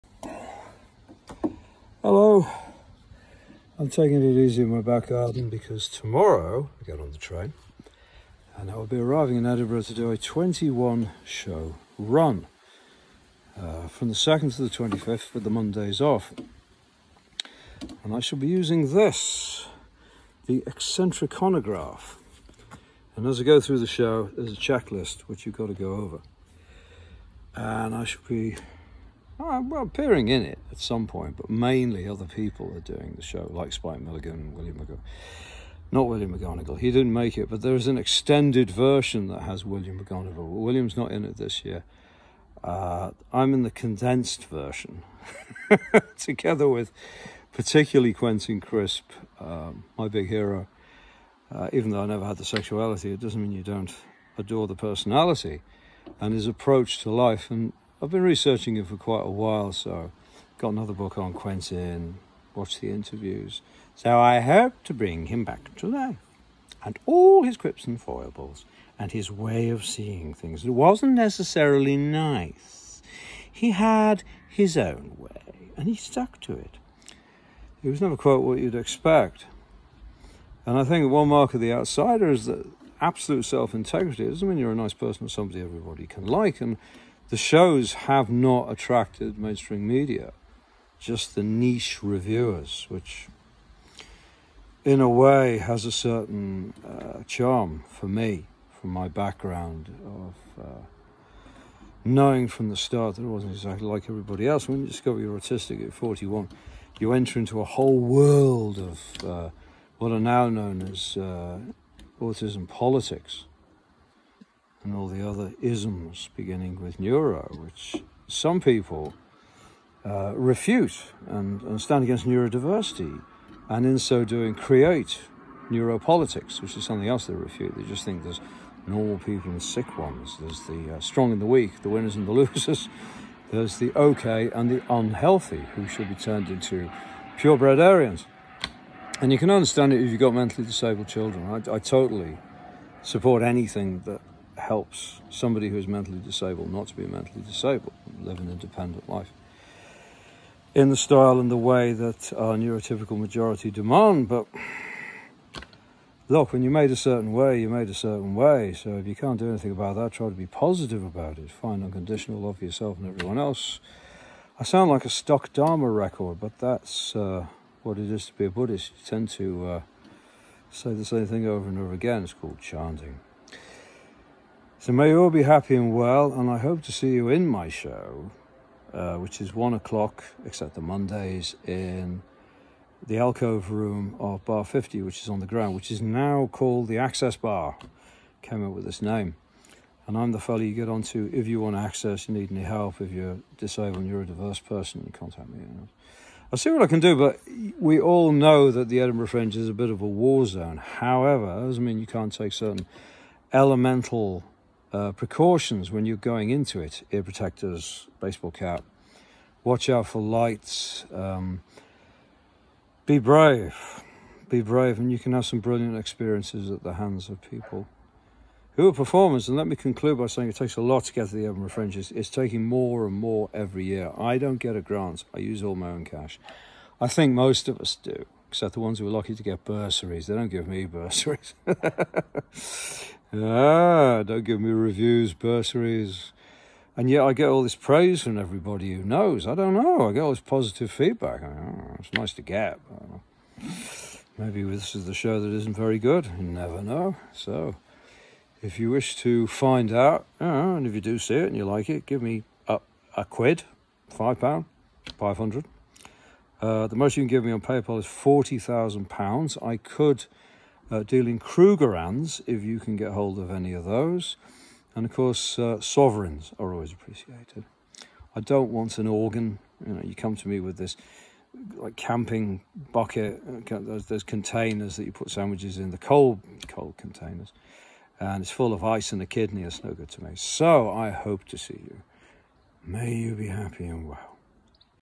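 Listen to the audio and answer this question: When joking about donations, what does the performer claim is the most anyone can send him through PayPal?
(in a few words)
£40,000.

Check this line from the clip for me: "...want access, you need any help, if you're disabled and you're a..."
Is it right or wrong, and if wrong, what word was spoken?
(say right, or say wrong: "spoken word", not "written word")
right.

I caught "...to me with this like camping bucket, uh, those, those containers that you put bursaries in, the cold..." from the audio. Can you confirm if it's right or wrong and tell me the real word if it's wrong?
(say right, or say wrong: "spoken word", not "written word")
wrong: "sandwiches", not "bursaries".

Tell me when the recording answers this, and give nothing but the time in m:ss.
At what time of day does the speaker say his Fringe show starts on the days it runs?
2:59.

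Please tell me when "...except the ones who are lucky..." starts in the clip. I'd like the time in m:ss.
3:48.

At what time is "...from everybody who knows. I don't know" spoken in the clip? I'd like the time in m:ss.
3:58.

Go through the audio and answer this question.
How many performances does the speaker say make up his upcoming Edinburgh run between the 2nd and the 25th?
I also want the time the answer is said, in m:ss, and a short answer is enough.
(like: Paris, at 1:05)
21, at 0:10.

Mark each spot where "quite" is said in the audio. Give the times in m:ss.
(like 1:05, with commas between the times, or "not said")
0:58, 1:18.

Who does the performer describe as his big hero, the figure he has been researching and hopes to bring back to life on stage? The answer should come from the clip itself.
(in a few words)
Quentin Crisp.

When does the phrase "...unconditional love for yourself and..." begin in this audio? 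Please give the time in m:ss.
2:41.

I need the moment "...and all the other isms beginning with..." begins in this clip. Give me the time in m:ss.
1:54.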